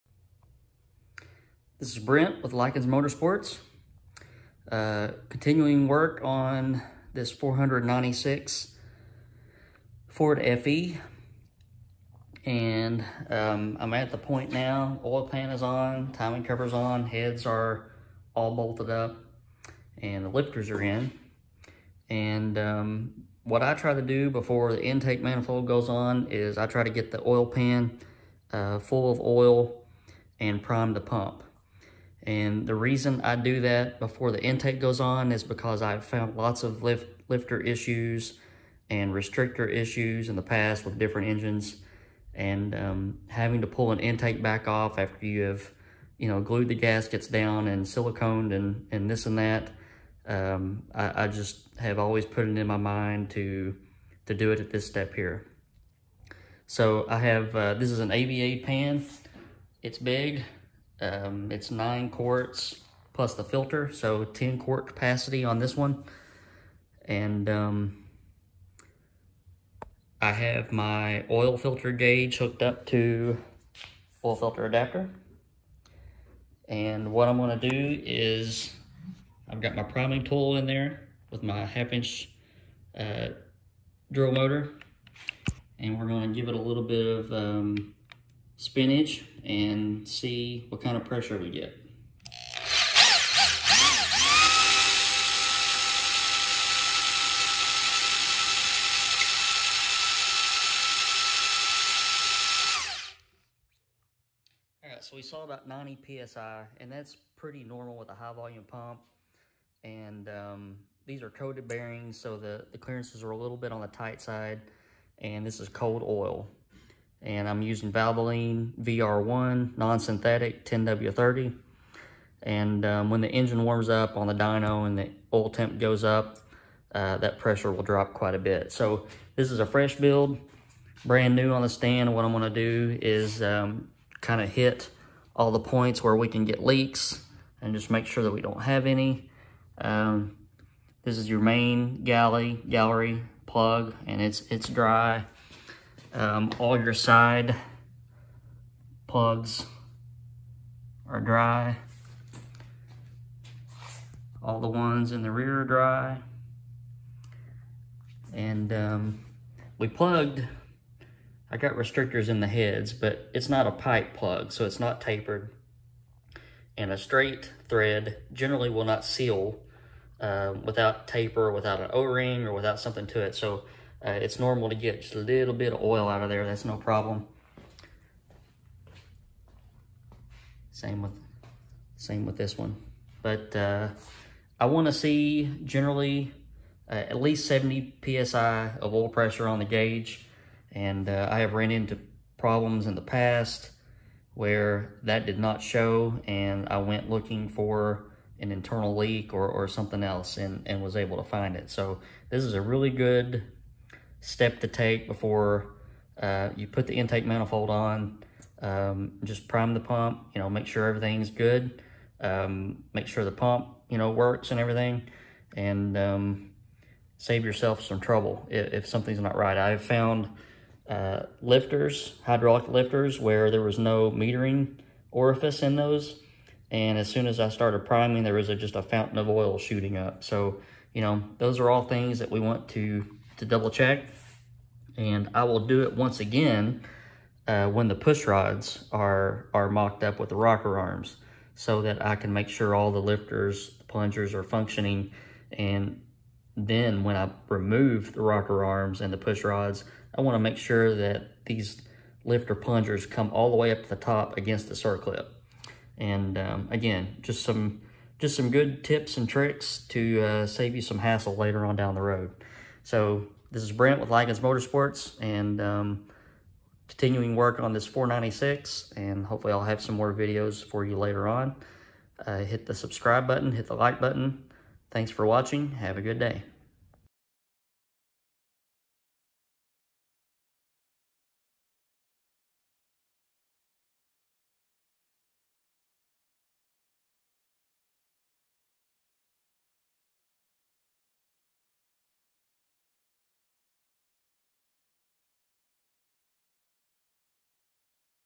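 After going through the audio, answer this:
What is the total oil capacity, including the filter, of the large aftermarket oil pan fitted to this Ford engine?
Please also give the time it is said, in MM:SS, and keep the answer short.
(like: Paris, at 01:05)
10 quarts, at 01:04.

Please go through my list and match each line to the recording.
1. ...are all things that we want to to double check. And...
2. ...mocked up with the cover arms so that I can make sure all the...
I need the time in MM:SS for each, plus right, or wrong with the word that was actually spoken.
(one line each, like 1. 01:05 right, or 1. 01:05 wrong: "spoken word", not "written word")
1. 03:51 right
2. 03:59 wrong: "rocker", not "cover".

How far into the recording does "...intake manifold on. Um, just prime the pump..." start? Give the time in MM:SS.
03:26.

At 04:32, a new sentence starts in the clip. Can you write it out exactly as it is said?
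Uh, hit the subscribe button, hit the like button.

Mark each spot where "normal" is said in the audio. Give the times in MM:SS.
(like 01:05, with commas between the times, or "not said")
01:47, 02:54.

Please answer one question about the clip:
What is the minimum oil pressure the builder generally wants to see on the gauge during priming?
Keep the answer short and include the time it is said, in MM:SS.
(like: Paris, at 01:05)
70 PSI, at 03:07.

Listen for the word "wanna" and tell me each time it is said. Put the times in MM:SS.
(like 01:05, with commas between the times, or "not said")
04:10.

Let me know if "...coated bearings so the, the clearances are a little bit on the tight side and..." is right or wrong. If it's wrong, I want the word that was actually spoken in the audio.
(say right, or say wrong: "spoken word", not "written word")
right.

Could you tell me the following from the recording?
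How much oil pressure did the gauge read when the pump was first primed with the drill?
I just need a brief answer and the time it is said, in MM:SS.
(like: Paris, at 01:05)
90 psi, at 01:45.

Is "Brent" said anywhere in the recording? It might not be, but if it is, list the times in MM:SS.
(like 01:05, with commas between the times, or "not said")
00:01, 04:23.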